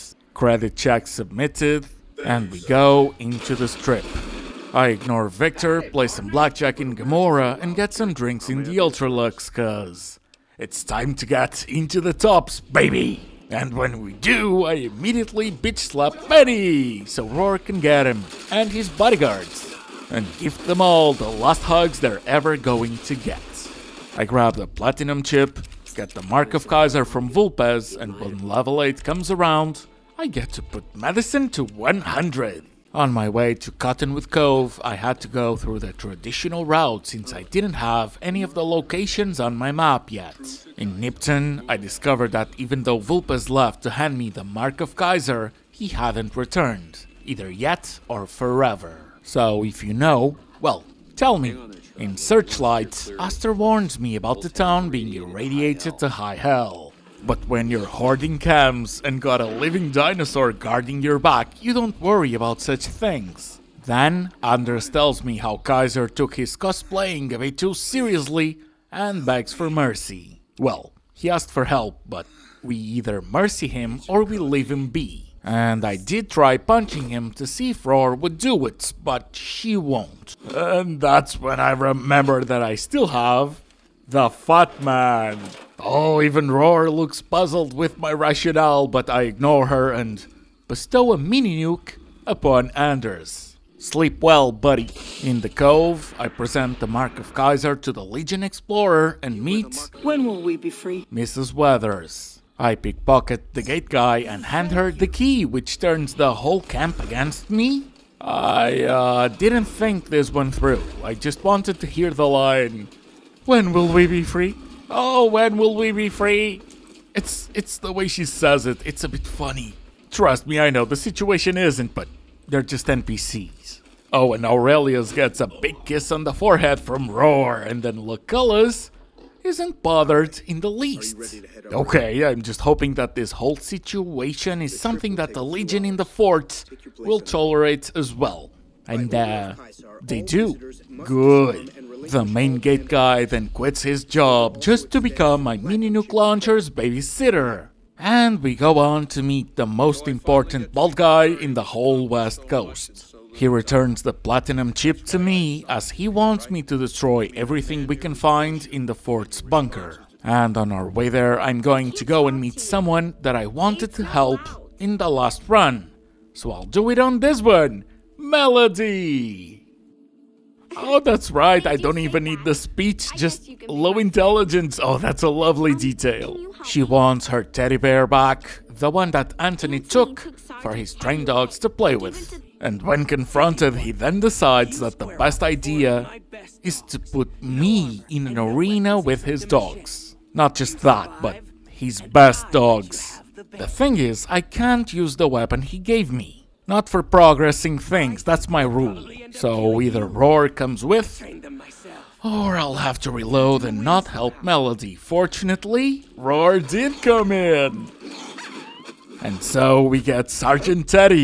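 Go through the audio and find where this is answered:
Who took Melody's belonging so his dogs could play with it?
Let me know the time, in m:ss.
2:59.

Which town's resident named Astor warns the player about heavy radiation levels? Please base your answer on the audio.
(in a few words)
Searchlight.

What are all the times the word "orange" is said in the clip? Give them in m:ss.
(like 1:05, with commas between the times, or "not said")
not said.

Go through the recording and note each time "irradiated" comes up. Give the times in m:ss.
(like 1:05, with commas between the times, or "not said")
0:55.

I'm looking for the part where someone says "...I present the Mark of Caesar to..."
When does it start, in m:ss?
1:36.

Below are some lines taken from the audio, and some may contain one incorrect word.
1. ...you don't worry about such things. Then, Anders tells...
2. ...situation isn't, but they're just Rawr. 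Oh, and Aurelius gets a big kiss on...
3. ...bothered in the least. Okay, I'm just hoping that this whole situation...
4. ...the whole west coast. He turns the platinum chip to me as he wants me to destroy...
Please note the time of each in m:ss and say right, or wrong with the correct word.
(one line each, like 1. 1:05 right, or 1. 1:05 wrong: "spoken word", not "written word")
1. 1:01 right
2. 2:01 wrong: "NPCs", not "Rawr"
3. 2:09 right
4. 2:31 wrong: "returns", not "turns".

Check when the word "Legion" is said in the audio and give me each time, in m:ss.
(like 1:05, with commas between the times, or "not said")
1:38, 2:15.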